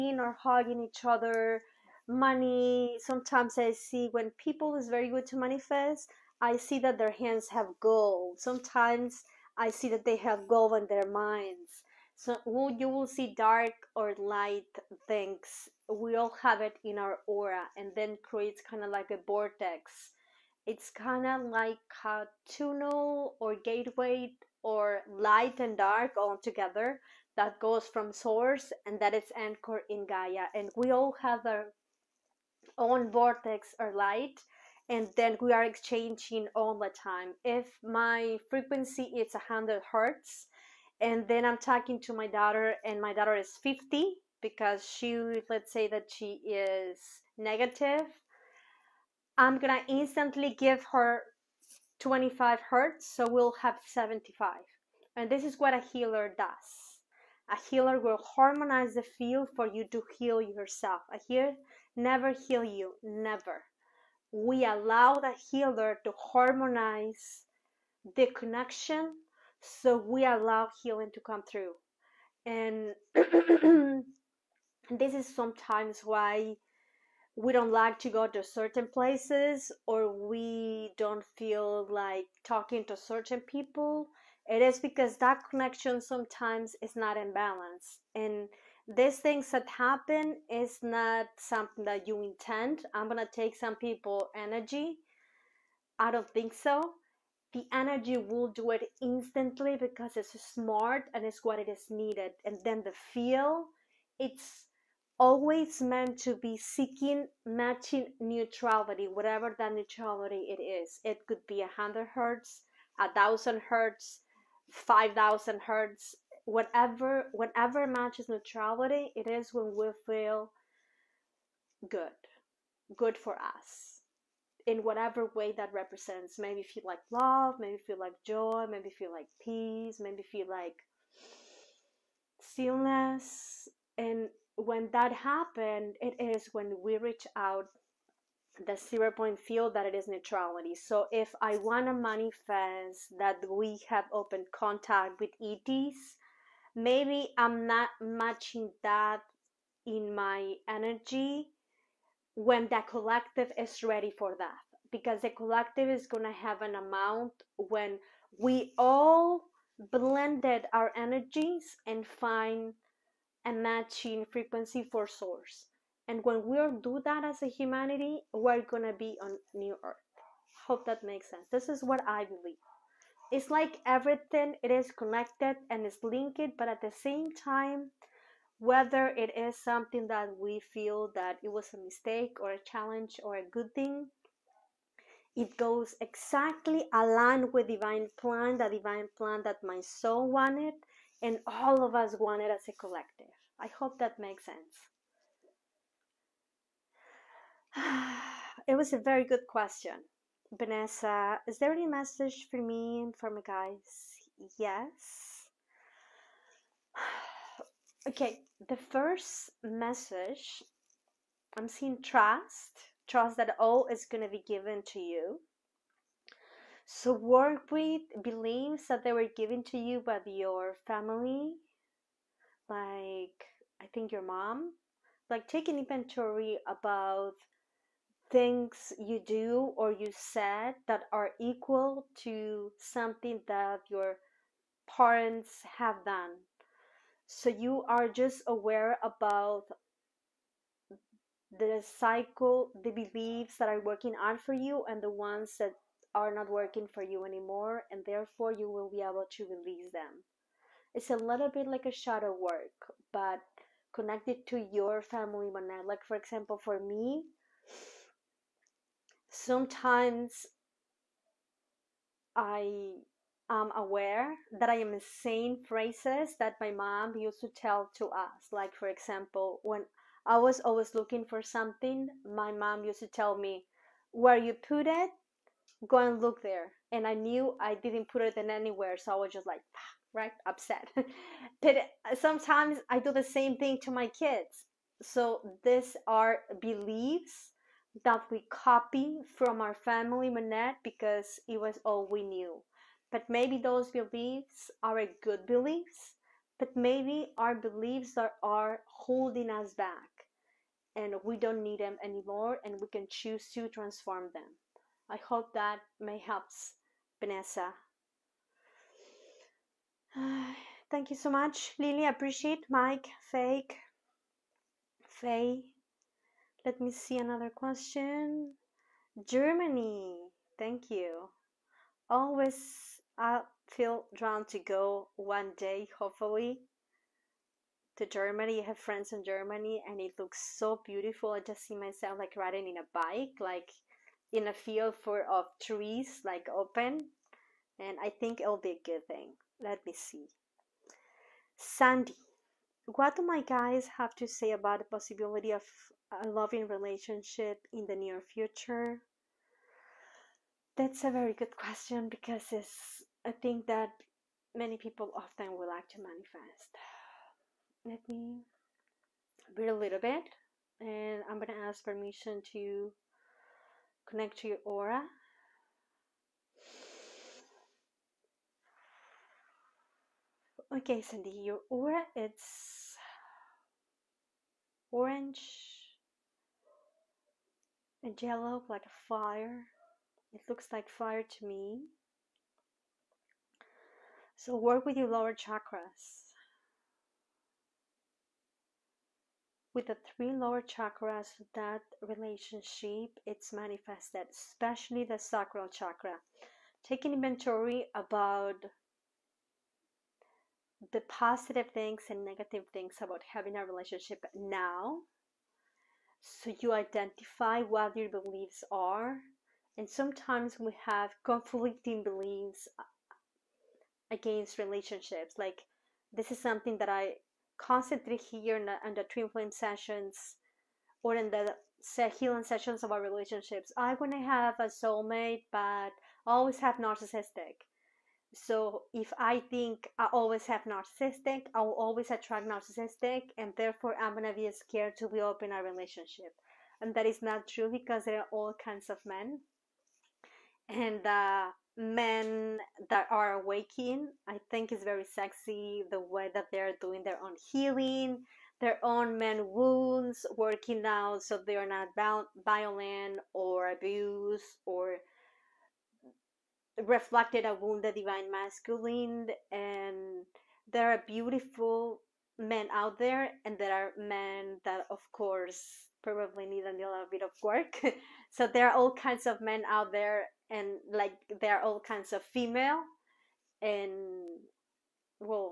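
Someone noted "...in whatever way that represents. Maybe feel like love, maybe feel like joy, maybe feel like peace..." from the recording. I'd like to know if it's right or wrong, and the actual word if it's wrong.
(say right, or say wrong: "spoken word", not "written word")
right.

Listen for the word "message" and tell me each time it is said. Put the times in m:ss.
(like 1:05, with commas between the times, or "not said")
3:21, 3:29.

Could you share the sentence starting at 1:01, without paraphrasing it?
A, healer never heal you, never.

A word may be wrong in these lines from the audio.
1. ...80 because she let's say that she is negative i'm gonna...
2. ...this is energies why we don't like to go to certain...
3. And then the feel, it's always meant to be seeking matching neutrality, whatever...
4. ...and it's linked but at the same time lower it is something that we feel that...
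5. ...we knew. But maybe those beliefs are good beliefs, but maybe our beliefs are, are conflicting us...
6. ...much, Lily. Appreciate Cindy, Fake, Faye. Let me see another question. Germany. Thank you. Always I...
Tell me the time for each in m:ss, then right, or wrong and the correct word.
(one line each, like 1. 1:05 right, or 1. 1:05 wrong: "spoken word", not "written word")
1. 0:43 wrong: "50", not "80"
2. 1:14 wrong: "sometimes", not "energies"
3. 1:42 right
4. 2:55 wrong: "whether", not "lower"
5. 4:52 wrong: "holding", not "conflicting"
6. 5:11 wrong: "Mike", not "Cindy".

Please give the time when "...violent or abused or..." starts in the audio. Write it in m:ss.
7:32.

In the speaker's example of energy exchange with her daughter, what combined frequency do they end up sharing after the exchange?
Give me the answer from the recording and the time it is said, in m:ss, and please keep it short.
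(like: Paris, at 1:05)
75, at 0:53.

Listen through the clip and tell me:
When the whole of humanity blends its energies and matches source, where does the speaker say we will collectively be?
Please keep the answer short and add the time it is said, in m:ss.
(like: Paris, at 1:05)
new earth, at 2:49.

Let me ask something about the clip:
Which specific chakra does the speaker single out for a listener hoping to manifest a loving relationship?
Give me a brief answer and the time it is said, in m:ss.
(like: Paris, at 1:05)
sacral chakra, at 6:35.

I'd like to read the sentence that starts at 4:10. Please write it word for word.
It's a little bit like a shadow work, but connected to your family magnet.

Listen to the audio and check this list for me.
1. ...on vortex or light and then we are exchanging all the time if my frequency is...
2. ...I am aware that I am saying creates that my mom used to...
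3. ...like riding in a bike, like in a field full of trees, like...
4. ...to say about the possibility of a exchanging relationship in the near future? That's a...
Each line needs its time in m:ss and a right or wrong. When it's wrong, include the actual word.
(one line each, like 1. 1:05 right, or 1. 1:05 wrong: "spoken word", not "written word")
1. 0:32 right
2. 4:22 wrong: "phrases", not "creates"
3. 5:32 right
4. 5:44 wrong: "loving", not "exchanging".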